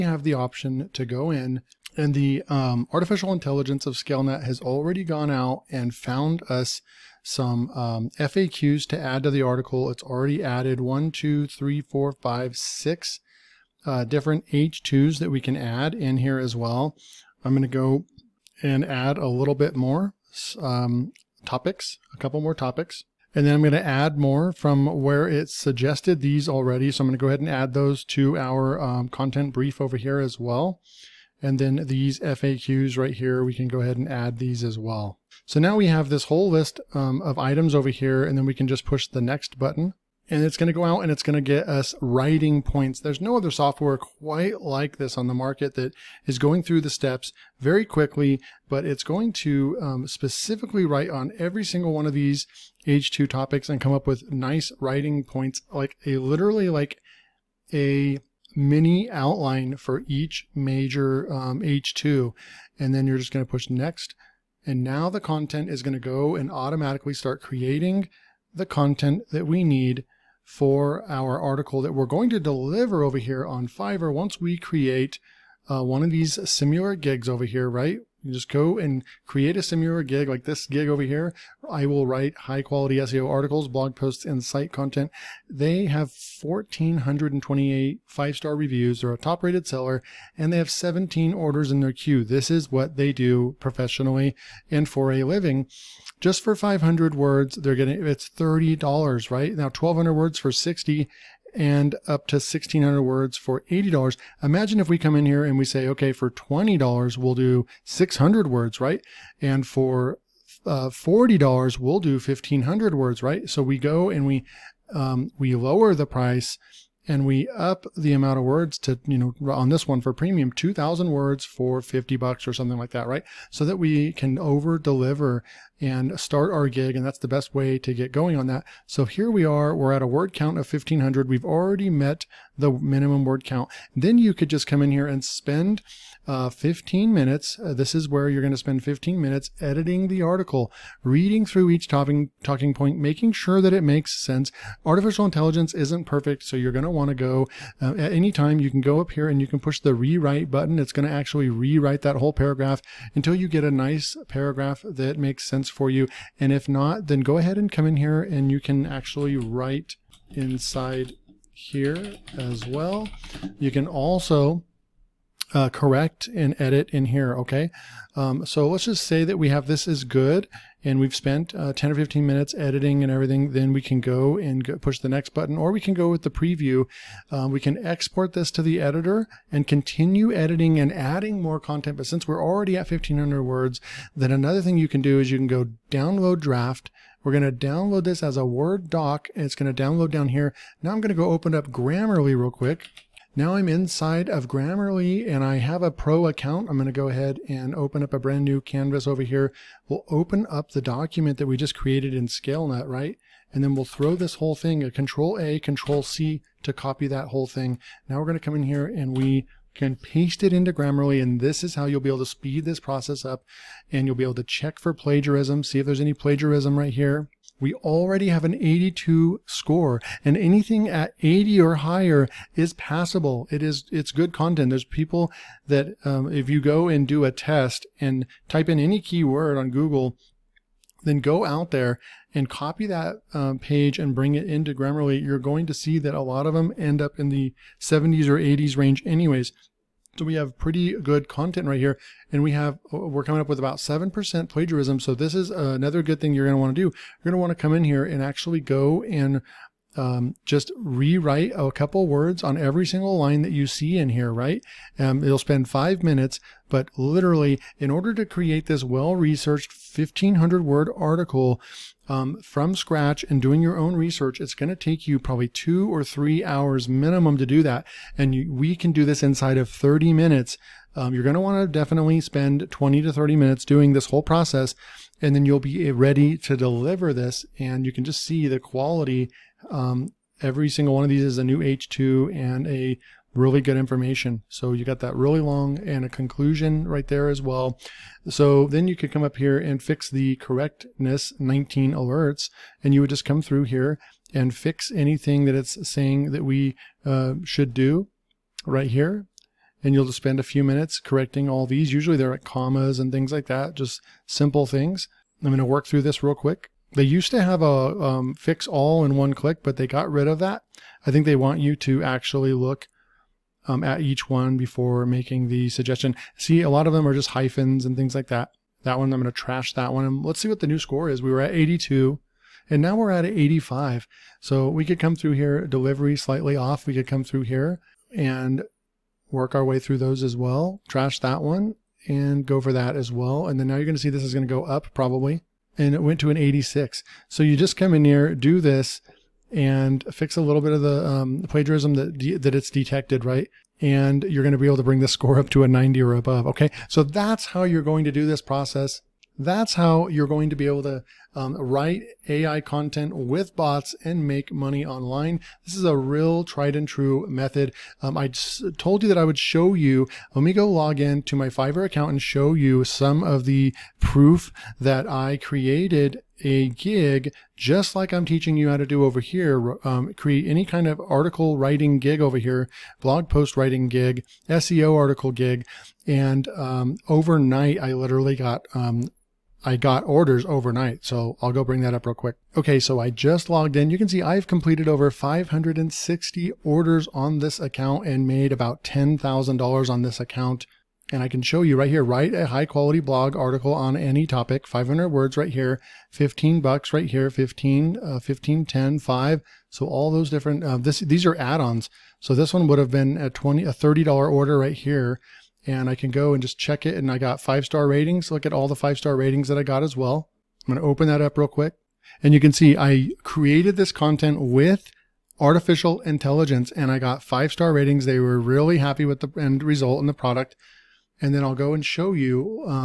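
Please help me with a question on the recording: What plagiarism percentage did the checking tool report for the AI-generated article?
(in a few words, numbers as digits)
7%.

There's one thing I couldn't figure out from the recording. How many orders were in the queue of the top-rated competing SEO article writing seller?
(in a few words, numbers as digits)
17.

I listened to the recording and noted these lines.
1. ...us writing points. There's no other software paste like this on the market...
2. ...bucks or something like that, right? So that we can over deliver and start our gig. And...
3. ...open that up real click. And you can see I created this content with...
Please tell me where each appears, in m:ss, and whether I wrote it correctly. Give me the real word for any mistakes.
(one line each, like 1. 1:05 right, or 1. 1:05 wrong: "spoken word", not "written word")
1. 0:41 wrong: "quite", not "paste"
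2. 2:02 right
3. 6:50 wrong: "quick", not "click".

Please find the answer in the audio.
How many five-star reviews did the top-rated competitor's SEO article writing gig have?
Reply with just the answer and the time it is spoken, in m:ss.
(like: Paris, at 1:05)
1,428, at 1:26.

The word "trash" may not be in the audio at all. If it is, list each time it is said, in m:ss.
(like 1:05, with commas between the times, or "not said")
5:19, 5:30.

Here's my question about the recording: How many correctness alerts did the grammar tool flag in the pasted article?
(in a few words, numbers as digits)
19.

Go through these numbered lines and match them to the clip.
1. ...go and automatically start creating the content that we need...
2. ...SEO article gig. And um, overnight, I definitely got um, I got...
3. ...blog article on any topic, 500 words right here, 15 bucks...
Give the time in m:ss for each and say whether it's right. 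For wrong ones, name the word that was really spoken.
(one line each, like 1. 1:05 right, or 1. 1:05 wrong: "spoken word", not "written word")
1. 1:05 right
2. 6:14 wrong: "literally", not "definitely"
3. 6:32 right.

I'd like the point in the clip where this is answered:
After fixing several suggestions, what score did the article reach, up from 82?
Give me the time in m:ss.
5:23.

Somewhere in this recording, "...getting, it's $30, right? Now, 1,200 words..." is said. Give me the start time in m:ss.
1:37.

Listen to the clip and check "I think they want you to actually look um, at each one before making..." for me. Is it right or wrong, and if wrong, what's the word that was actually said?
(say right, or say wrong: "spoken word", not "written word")
right.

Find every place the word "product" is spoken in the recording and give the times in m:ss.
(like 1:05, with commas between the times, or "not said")
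7:00.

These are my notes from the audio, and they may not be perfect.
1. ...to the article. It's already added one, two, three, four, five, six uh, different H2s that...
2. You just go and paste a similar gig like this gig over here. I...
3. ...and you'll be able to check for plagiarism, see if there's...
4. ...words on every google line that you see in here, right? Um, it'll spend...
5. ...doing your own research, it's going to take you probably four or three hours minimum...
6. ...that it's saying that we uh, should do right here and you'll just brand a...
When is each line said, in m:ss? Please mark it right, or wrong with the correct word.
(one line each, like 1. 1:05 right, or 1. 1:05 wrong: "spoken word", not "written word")
1. 0:09 right
2. 1:18 wrong: "create", not "paste"
3. 3:33 right
4. 4:12 wrong: "single", not "google"
5. 4:23 wrong: "two", not "four"
6. 4:55 wrong: "spend", not "brand".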